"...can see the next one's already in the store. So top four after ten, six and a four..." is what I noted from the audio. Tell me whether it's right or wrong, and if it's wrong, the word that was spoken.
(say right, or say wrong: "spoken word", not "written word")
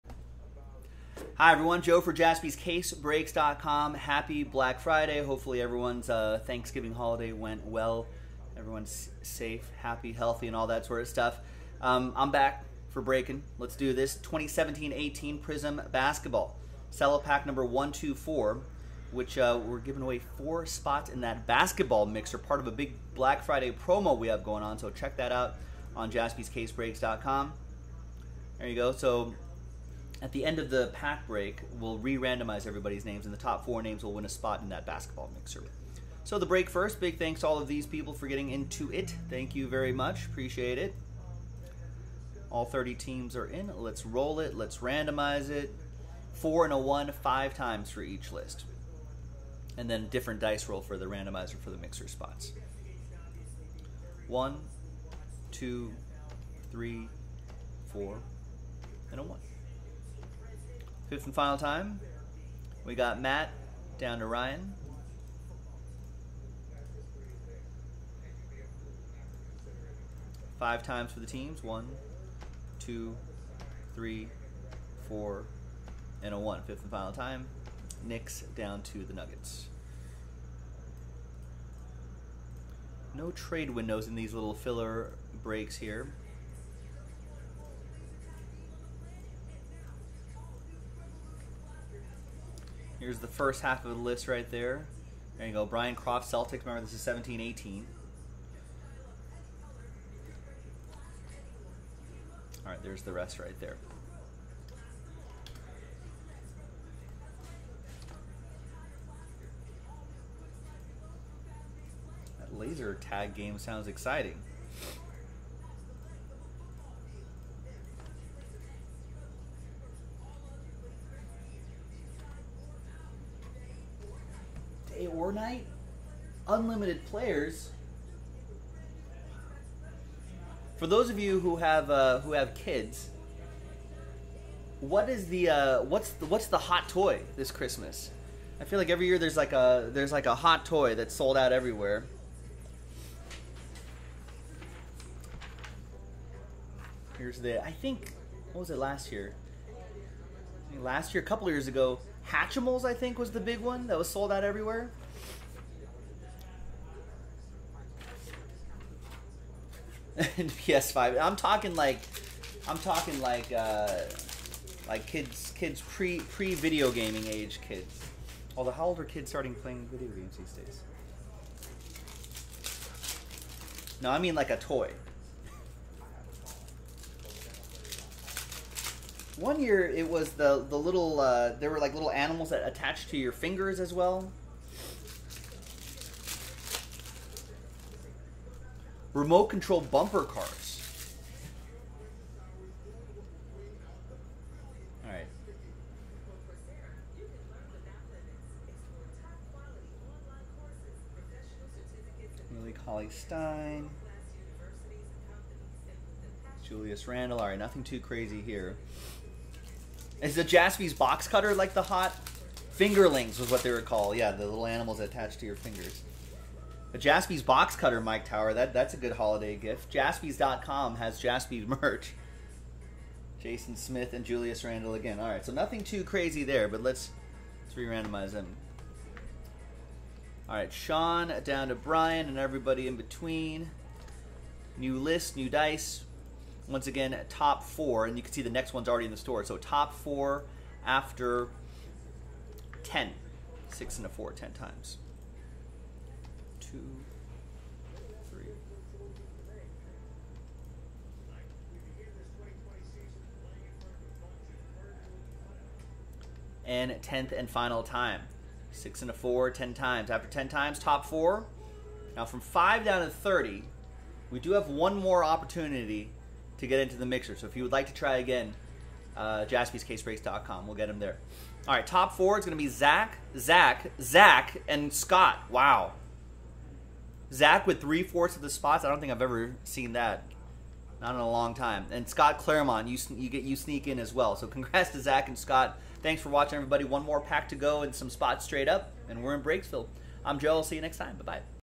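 right.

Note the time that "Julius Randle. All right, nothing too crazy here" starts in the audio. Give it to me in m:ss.
3:26.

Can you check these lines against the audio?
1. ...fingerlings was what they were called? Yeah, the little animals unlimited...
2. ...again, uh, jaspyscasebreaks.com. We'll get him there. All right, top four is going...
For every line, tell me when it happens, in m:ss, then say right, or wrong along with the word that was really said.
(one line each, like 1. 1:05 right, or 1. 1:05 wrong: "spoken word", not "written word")
1. 3:32 wrong: "attached", not "unlimited"
2. 4:28 right.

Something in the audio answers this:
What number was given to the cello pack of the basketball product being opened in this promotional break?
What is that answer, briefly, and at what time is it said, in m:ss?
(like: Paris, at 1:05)
124, at 0:17.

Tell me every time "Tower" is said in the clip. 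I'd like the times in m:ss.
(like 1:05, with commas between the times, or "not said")
3:38.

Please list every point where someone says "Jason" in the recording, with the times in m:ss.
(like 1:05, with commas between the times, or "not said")
3:43.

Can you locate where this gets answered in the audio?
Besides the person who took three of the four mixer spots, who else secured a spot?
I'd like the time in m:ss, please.
4:42.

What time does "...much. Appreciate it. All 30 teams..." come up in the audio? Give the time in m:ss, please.
0:39.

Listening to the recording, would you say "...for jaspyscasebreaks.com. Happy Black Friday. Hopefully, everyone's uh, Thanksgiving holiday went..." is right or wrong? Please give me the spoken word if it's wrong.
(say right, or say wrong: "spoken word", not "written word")
right.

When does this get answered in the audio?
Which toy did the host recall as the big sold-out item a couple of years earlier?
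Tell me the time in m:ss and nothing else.
2:32.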